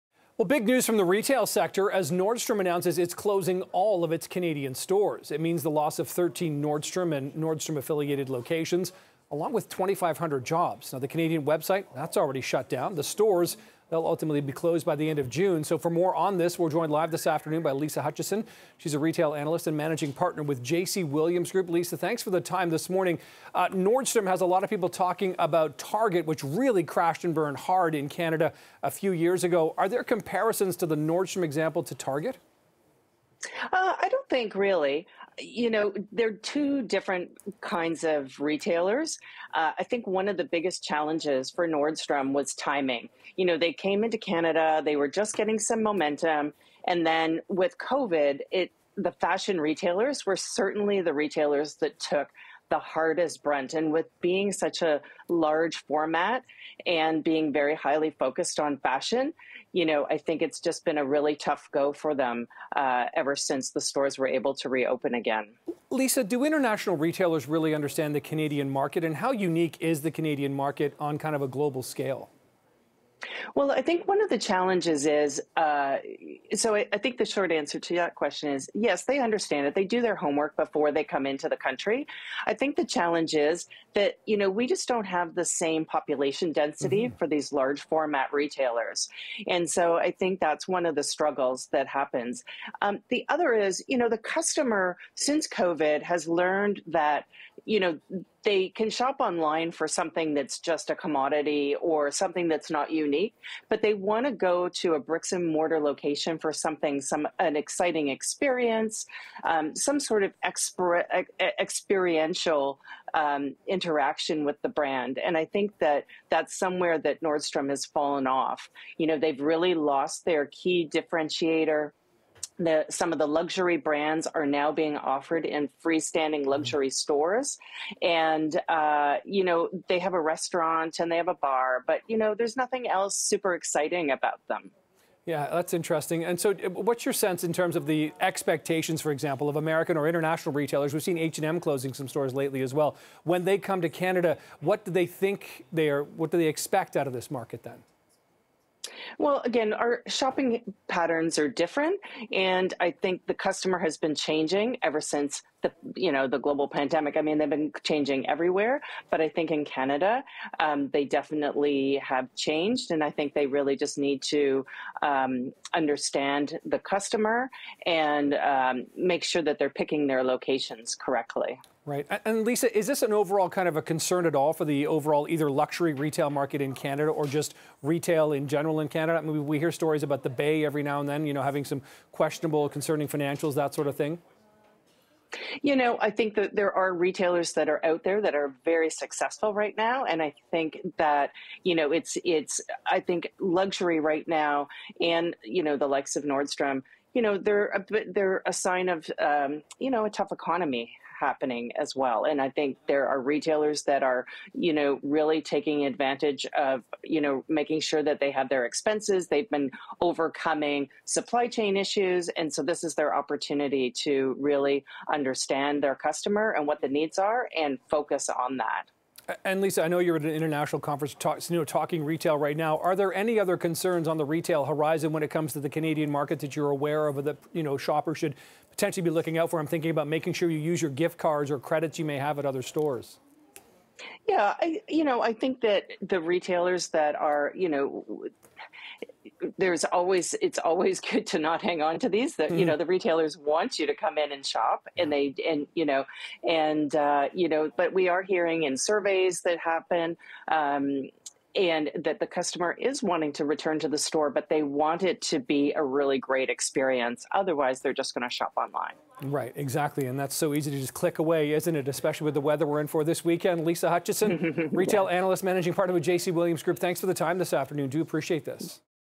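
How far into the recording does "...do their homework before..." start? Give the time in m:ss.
1:19.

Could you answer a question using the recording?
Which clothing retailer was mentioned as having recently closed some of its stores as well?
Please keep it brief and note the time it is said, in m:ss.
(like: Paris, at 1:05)
H&M, at 2:21.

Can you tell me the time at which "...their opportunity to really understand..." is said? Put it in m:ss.
3:32.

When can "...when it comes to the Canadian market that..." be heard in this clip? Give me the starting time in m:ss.
3:45.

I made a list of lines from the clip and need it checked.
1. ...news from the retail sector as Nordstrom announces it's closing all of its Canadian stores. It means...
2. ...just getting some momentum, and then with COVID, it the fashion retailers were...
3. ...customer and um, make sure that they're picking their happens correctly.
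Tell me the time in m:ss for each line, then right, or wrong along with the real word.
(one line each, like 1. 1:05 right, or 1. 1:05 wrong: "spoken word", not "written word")
1. 0:00 right
2. 0:45 right
3. 2:46 wrong: "locations", not "happens".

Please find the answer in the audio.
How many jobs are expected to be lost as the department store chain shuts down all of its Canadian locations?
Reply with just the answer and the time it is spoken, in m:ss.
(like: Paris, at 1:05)
2,500, at 0:09.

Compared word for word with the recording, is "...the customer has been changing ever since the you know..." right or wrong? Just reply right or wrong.
right.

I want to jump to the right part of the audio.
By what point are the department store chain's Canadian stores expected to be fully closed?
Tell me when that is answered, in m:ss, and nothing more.
0:15.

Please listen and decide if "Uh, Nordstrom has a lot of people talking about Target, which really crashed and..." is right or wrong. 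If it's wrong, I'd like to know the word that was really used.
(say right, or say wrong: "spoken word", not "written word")
right.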